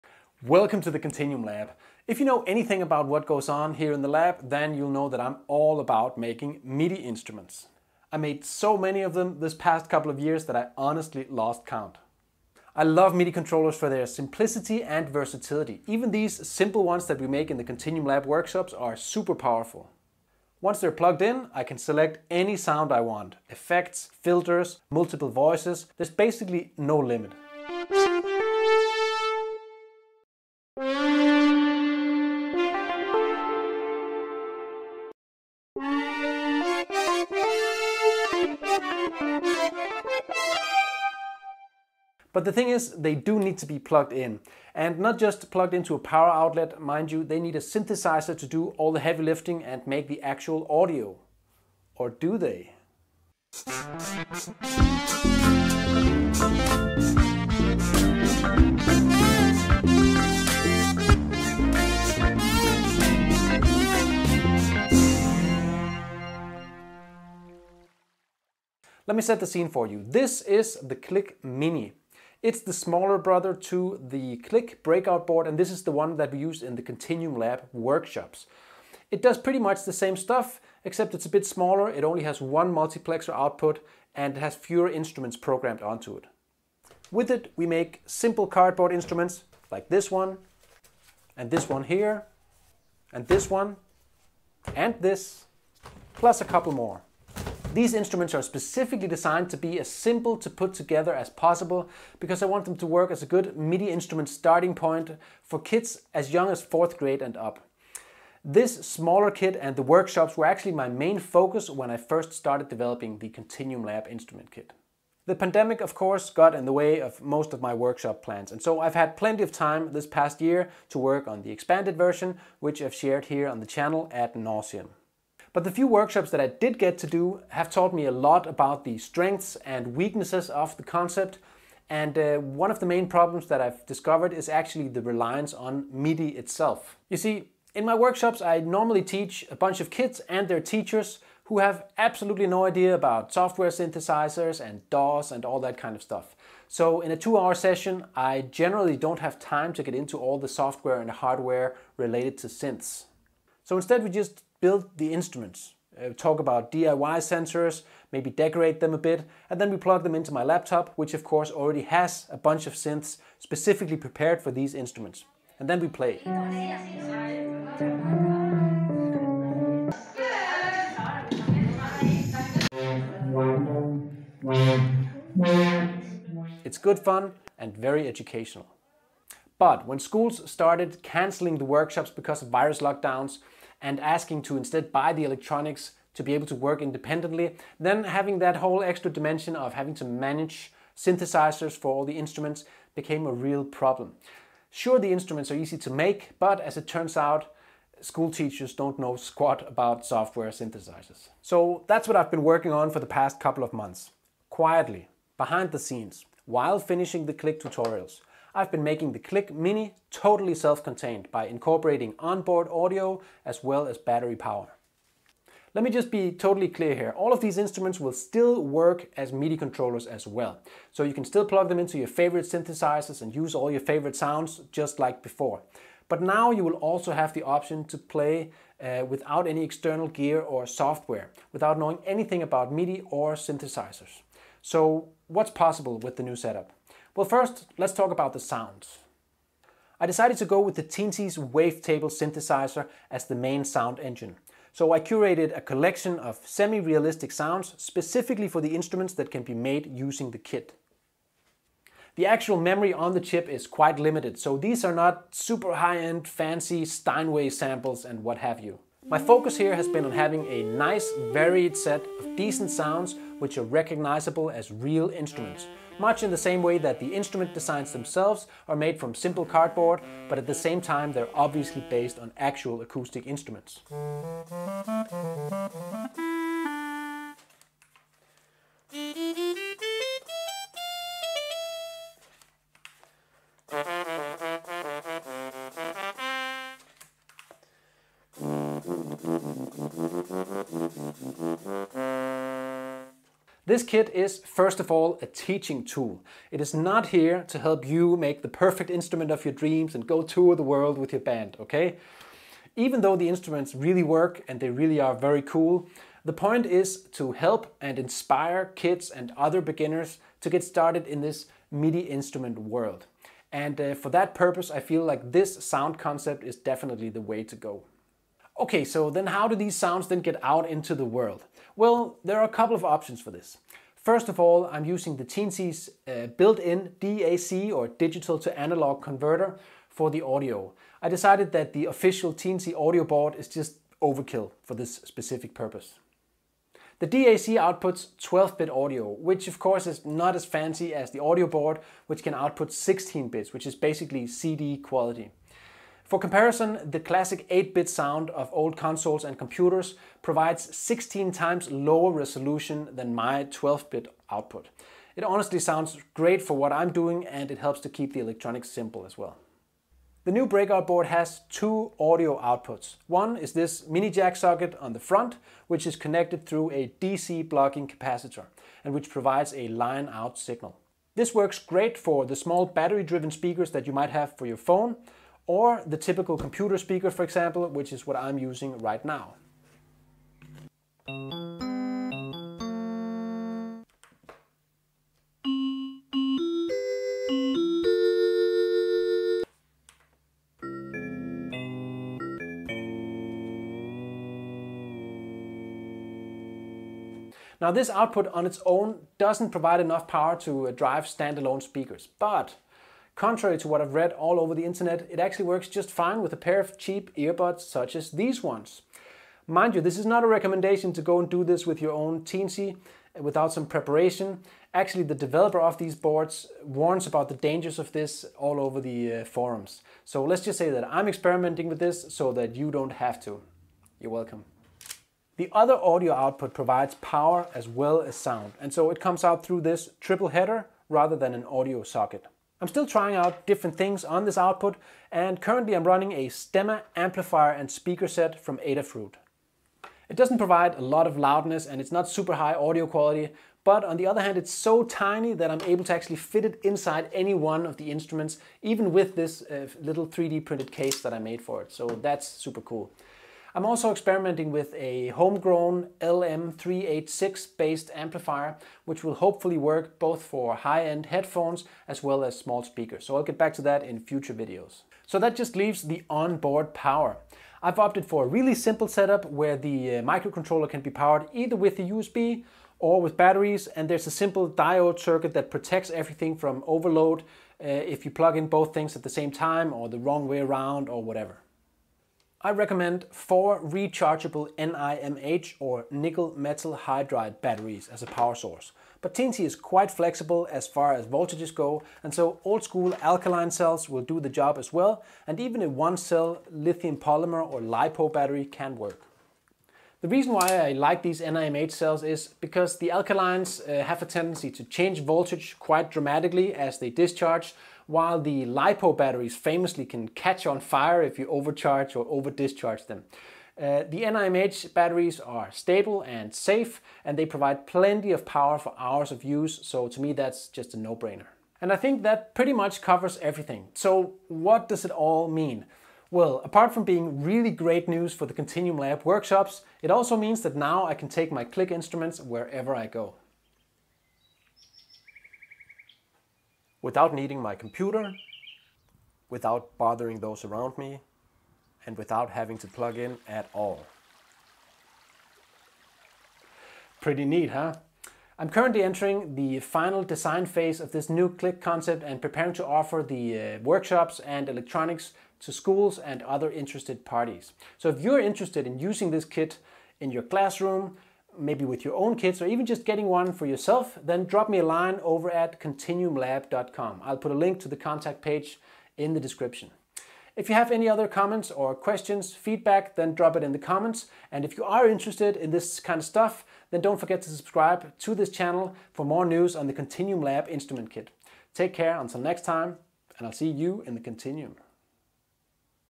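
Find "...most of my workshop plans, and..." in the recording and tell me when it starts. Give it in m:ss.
1:57.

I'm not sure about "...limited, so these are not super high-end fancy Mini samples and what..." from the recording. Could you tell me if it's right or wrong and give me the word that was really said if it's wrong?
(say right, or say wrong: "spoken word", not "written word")
wrong: "Steinway", not "Mini".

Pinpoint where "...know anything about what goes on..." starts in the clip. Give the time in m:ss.
0:02.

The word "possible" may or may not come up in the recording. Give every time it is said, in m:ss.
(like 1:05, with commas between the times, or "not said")
1:41, 3:55.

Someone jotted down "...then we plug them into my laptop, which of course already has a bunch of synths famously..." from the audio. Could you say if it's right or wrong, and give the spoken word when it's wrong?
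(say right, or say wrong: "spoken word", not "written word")
wrong: "specifically", not "famously".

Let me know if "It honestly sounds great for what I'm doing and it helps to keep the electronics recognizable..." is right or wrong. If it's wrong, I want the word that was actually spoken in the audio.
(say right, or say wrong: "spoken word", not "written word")
wrong: "simple", not "recognizable".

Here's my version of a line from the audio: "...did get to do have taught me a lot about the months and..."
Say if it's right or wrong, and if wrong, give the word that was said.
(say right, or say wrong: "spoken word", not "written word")
wrong: "strengths", not "months".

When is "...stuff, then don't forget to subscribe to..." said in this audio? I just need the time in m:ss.
9:36.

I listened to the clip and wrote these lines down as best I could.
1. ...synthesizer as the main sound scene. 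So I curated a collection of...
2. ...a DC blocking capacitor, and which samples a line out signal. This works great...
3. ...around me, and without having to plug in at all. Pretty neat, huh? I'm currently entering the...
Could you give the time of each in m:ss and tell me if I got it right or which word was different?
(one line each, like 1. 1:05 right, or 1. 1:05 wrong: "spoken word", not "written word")
1. 4:02 wrong: "engine", not "scene"
2. 6:06 wrong: "provides", not "samples"
3. 9:00 right.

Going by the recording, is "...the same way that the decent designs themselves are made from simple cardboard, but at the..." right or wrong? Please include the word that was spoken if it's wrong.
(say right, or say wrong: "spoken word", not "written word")
wrong: "instrument", not "decent".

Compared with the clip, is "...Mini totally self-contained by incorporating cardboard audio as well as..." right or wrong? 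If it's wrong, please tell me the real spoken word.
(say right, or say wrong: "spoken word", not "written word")
wrong: "onboard", not "cardboard".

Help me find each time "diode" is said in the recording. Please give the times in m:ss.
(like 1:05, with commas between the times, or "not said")
7:54.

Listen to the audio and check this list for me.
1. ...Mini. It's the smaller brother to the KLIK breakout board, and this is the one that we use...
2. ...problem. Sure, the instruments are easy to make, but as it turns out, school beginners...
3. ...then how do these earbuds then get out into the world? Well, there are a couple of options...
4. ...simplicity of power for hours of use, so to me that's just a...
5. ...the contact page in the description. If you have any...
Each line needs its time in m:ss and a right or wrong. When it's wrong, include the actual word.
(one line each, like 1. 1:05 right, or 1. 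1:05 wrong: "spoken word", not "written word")
1. 1:11 right
2. 3:13 wrong: "teachers", not "beginners"
3. 5:19 wrong: "sounds", not "earbuds"
4. 8:37 wrong: "plenty", not "simplicity"
5. 9:27 right.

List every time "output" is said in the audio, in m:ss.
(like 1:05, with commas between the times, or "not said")
1:23, 5:37, 5:42, 5:54, 6:02, 6:37, 7:06, 7:14.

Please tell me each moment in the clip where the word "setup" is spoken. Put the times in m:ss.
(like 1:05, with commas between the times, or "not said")
3:56, 7:48.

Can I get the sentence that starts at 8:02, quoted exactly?
I recommend four rechargeable NIMH or nickel metal hydride batteries as a power source.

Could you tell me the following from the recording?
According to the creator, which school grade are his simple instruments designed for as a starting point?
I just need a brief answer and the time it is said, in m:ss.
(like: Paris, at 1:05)
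4th grade, at 1:46.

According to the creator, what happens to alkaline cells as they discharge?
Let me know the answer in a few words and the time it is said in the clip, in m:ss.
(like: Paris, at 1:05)
change voltage, at 8:24.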